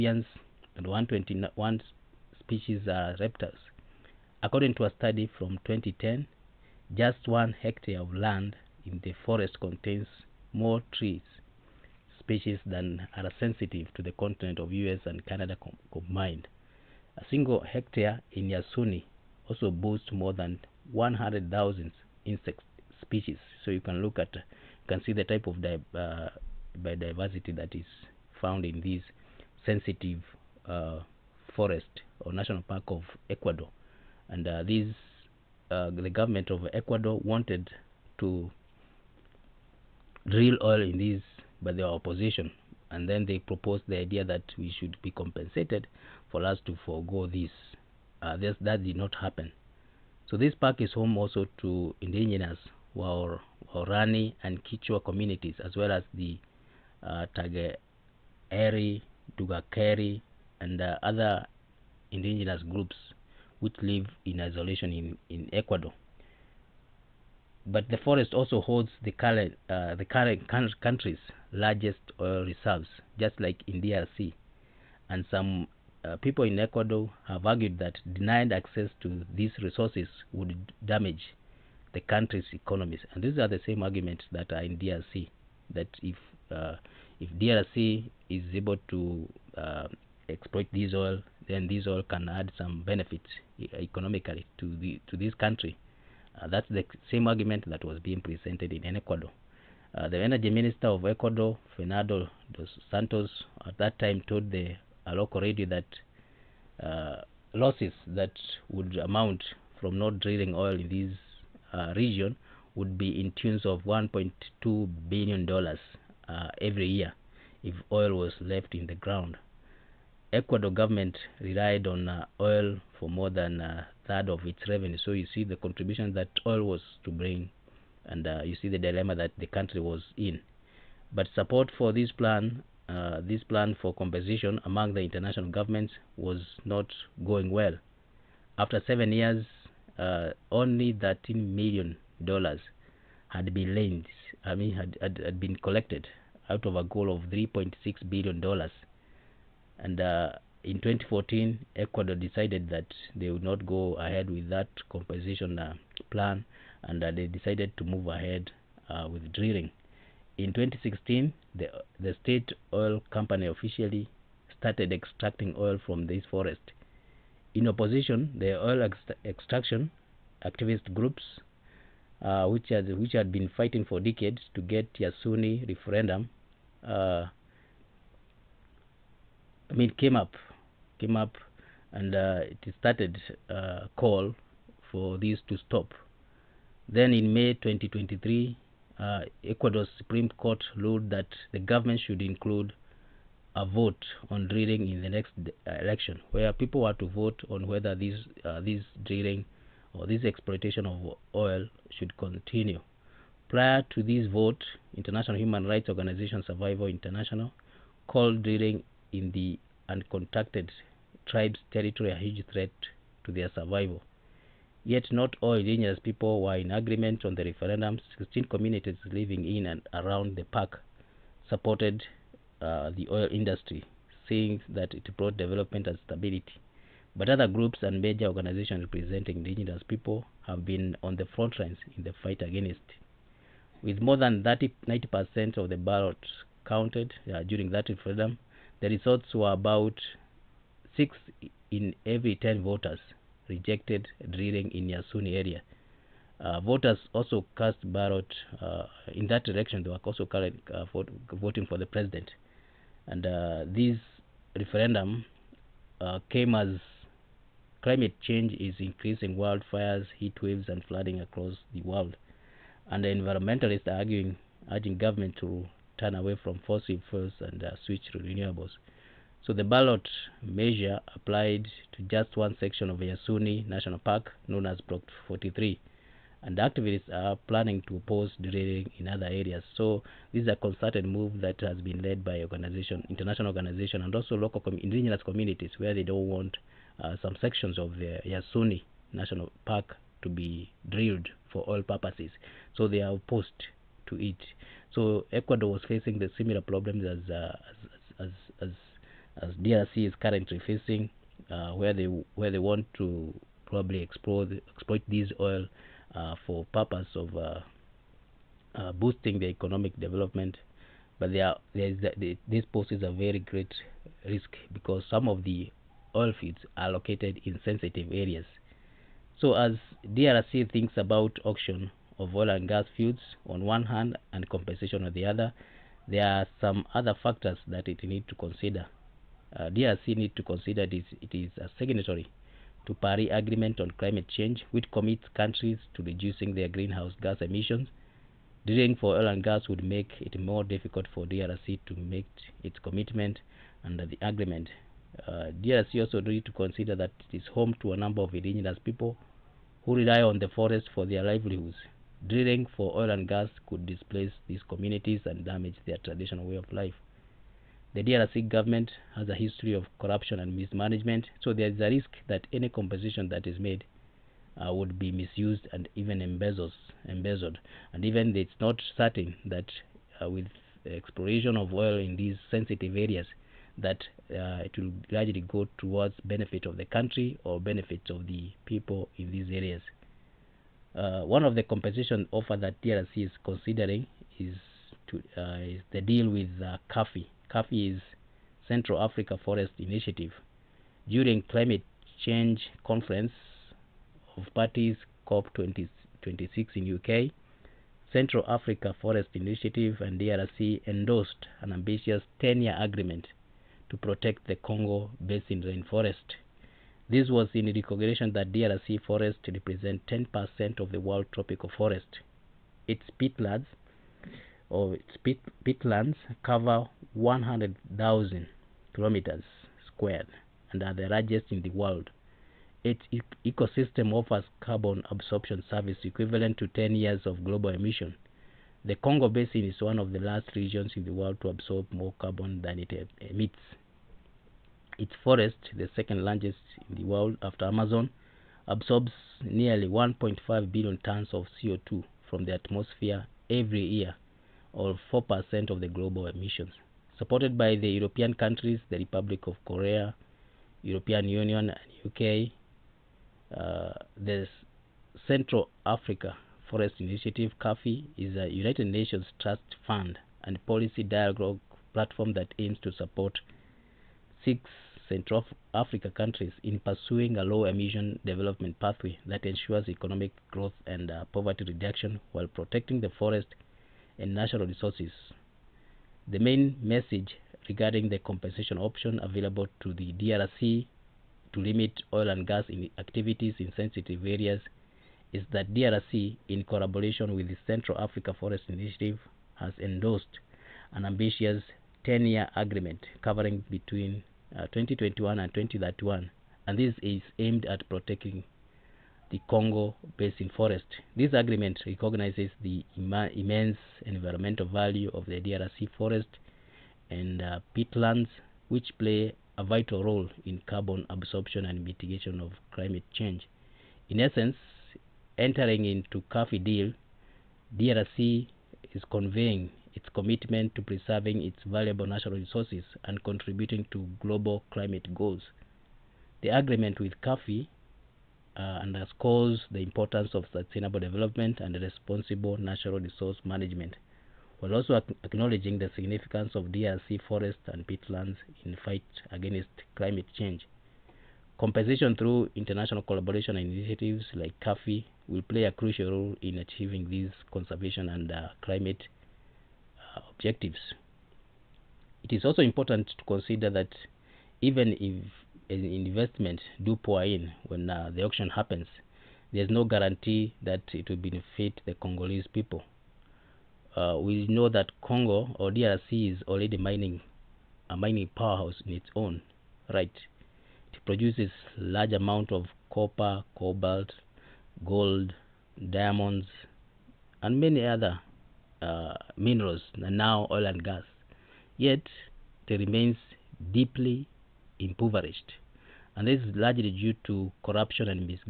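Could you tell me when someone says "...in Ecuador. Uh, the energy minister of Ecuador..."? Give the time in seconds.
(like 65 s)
98 s.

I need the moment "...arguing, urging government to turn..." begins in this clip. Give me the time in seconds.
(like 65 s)
263 s.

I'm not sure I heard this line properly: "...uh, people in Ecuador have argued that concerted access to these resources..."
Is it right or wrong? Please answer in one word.
wrong.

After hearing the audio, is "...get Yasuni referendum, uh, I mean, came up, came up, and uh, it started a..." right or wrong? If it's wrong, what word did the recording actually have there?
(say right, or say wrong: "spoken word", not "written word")
right.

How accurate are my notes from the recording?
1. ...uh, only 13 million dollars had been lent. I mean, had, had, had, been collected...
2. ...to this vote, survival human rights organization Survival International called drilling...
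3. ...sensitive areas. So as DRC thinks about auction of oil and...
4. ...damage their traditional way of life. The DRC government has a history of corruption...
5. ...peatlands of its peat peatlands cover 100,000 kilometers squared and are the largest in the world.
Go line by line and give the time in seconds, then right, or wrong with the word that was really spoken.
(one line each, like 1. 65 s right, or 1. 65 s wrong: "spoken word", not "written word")
1. 139 s right
2. 203 s wrong: "international", not "survival"
3. 317 s right
4. 355 s right
5. 413 s right.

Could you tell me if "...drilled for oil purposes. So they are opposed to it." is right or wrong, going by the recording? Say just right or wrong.
right.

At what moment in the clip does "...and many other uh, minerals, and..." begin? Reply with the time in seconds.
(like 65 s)
577 s.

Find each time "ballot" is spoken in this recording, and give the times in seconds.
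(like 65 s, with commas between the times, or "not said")
235 s, 247 s, 269 s.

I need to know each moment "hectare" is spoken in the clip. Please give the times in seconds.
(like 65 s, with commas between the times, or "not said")
7 s, 17 s.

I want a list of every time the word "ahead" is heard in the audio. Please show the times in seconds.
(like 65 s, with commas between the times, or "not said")
153 s, 158 s.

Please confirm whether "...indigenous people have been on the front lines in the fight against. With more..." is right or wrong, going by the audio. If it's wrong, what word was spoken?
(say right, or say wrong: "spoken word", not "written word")
right.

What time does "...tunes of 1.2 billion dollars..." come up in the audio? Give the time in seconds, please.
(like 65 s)
113 s.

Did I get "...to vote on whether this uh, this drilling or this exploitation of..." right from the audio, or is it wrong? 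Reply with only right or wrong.
right.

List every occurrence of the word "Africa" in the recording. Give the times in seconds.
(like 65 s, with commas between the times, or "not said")
389 s, 398 s, 455 s, 465 s, 487 s.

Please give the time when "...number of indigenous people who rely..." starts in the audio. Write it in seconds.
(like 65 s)
347 s.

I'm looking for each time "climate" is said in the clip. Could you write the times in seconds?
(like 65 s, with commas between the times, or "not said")
257 s, 333 s, 391 s, 512 s, 524 s, 539 s, 548 s.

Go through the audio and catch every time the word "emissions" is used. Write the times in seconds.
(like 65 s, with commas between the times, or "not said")
337 s, 427 s, 446 s, 467 s.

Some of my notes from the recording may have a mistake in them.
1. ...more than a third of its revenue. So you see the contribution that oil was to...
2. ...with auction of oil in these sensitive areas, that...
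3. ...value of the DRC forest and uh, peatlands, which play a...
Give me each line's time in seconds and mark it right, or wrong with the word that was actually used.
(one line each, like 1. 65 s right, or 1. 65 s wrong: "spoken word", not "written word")
1. 123 s right
2. 370 s wrong: "exploration", not "auction"
3. 504 s right.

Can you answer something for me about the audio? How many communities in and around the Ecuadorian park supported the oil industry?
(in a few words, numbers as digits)
16.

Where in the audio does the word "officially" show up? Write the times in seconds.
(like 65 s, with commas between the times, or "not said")
163 s.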